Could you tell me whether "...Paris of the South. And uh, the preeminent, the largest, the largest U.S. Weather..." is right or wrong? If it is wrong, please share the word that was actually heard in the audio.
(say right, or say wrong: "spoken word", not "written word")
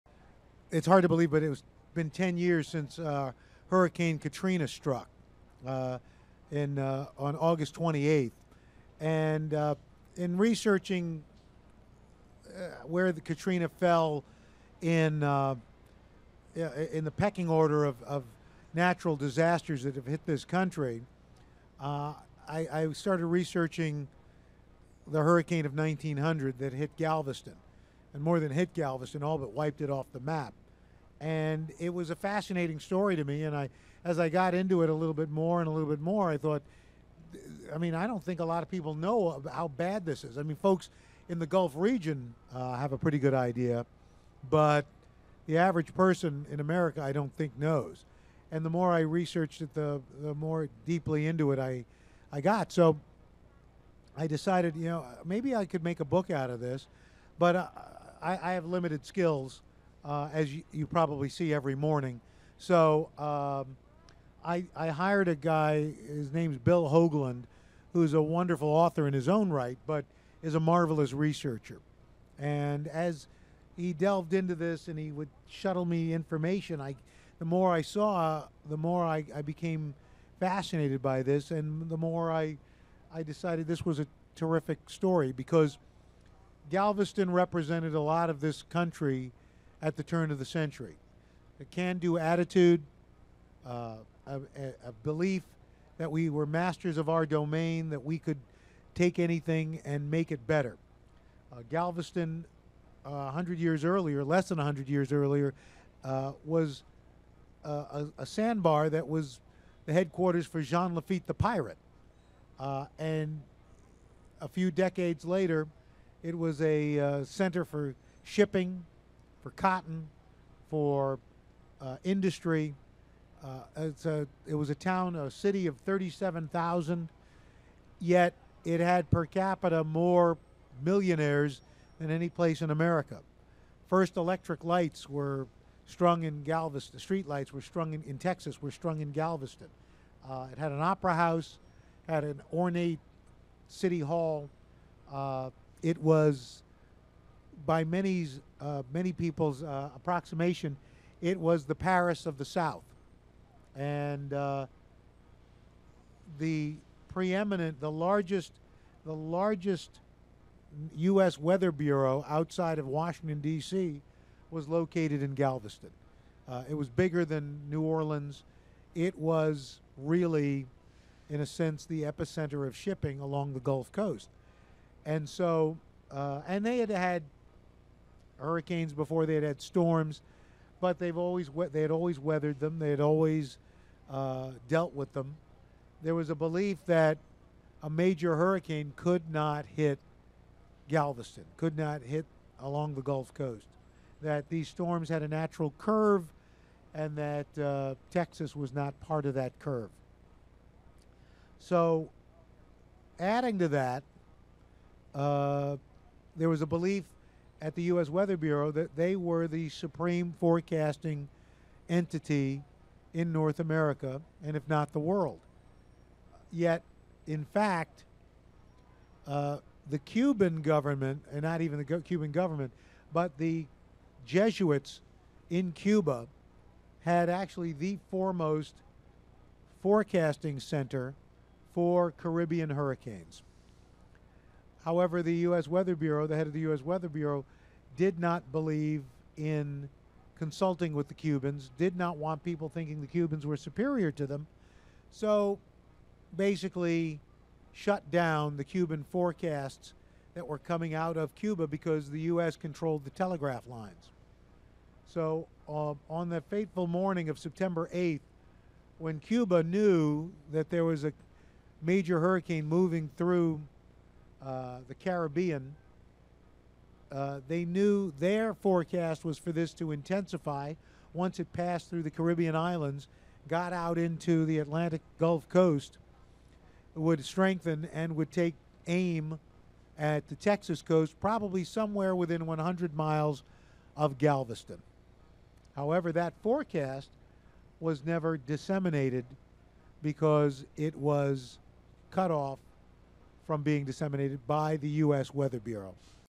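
right.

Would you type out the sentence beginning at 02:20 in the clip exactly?
Uh, it had an opera house, had an ornate city hall.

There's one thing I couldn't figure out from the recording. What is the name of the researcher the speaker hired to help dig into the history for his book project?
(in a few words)
Bill Hoagland.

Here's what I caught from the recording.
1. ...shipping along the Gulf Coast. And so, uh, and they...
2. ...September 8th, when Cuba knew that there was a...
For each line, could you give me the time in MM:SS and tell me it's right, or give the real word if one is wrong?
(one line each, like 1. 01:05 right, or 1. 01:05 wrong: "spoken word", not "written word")
1. 02:52 right
2. 04:17 right.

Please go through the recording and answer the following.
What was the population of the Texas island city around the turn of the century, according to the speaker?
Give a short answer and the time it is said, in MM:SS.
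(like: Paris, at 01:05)
37,000, at 02:05.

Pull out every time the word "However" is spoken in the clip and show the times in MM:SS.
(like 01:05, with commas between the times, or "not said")
03:54, 04:45.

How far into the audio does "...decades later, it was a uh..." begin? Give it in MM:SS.
01:54.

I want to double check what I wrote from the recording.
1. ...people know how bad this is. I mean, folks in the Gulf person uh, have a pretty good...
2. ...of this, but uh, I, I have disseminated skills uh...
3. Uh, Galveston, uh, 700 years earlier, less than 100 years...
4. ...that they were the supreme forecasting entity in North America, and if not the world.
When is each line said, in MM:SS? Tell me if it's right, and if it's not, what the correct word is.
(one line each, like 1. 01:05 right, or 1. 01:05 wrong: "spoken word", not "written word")
1. 00:38 wrong: "region", not "person"
2. 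00:56 wrong: "limited", not "disseminated"
3. 01:41 wrong: "100", not "700"
4. 03:28 right.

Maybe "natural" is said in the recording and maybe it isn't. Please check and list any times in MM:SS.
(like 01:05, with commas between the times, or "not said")
00:18, 03:15.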